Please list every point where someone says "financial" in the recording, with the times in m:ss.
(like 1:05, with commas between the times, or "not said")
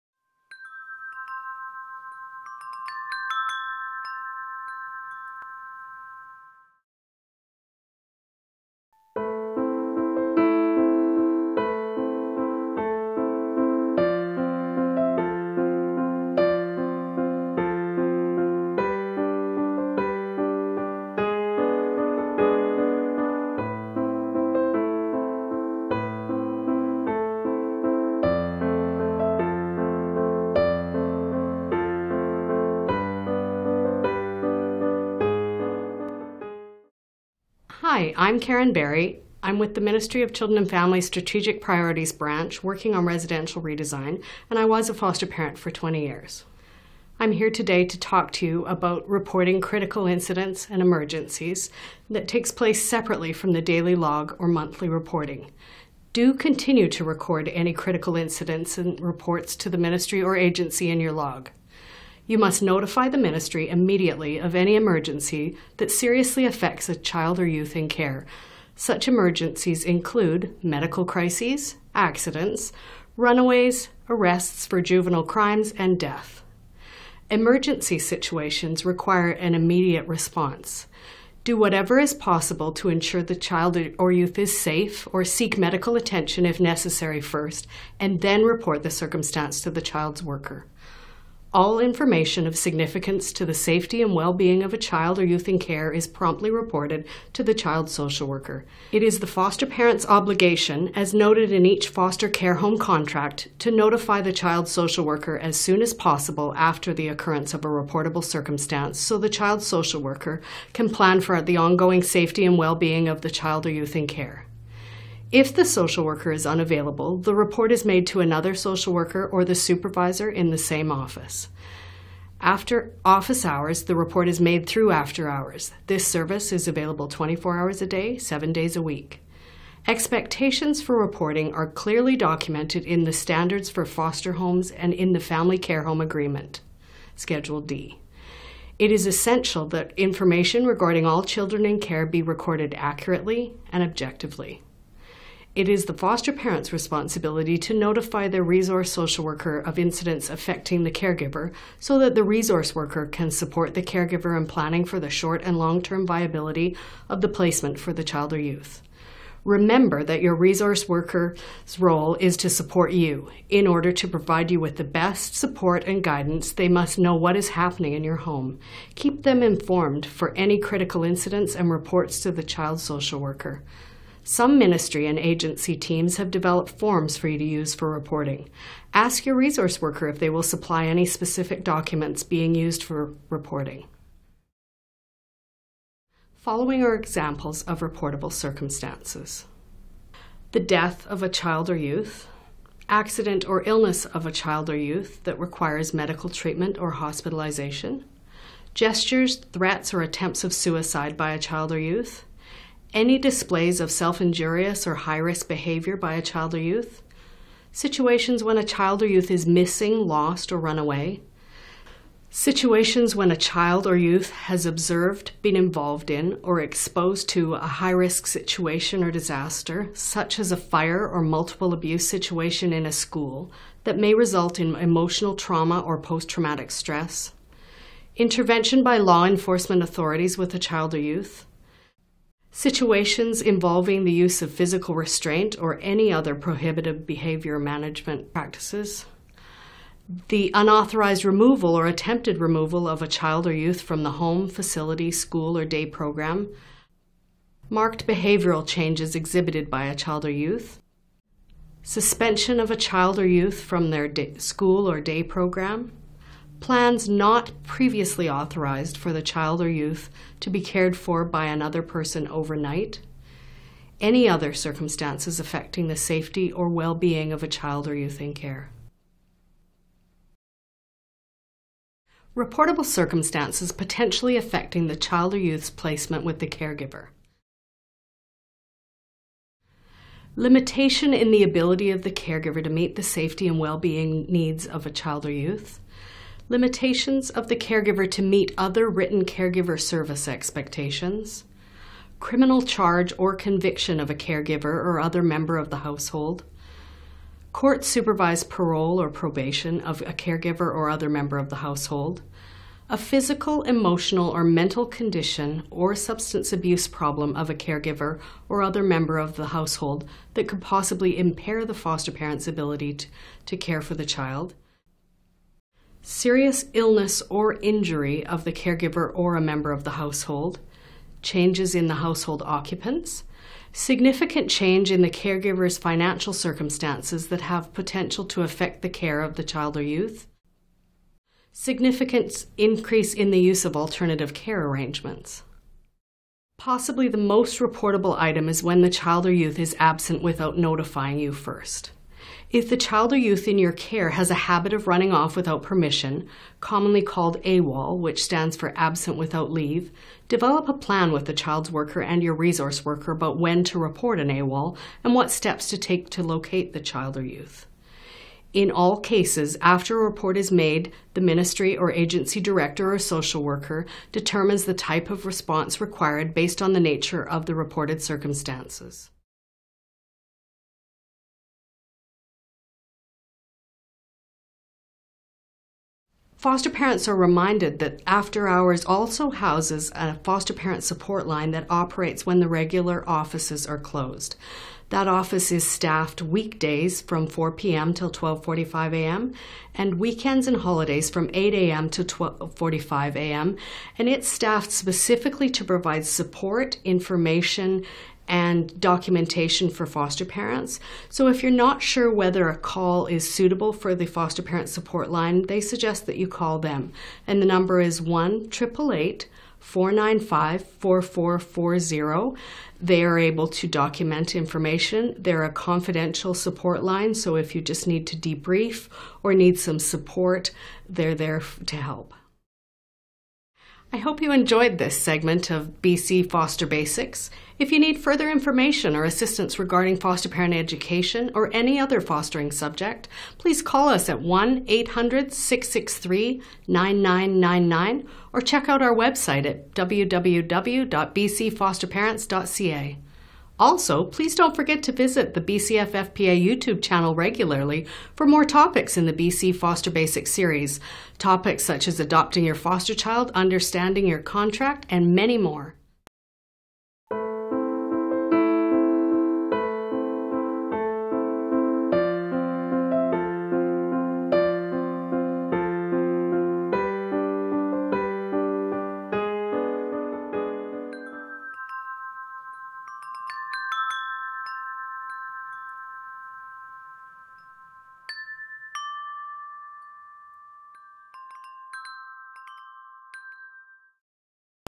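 5:25.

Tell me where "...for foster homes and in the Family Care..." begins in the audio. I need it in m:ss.
2:13.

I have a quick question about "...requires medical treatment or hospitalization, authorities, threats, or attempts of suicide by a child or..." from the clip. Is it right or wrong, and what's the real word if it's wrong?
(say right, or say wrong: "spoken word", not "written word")
wrong: "gestures", not "authorities".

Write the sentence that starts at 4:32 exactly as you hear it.
Reportable circumstances potentially affecting the child or youth's placement with the caregiver.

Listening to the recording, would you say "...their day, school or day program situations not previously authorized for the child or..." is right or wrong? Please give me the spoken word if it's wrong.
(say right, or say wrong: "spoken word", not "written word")
wrong: "plans", not "situations".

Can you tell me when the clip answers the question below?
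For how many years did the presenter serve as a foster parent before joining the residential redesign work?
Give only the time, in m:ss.
0:45.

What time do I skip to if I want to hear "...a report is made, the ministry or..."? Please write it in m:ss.
5:59.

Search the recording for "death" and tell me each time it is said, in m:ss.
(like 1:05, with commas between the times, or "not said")
1:15, 3:10.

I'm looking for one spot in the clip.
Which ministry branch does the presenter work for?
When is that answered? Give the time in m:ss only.
0:41.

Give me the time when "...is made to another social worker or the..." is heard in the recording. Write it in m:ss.
1:57.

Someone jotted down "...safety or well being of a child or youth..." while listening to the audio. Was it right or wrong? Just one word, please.
right.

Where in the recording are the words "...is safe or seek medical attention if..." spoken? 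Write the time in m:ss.
1:24.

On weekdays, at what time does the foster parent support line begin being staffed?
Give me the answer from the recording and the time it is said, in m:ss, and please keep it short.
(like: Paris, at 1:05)
4 p.m., at 6:27.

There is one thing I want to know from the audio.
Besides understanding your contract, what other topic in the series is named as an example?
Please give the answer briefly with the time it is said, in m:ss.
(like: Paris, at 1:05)
adopting your foster child, at 7:31.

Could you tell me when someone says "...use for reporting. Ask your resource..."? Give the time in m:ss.
2:57.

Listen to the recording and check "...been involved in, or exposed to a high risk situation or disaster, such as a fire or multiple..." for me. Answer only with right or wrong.
right.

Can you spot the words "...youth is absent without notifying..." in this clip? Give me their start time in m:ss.
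5:39.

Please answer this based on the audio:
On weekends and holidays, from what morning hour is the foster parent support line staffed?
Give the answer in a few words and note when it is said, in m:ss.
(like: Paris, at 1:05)
8 a.m., at 6:31.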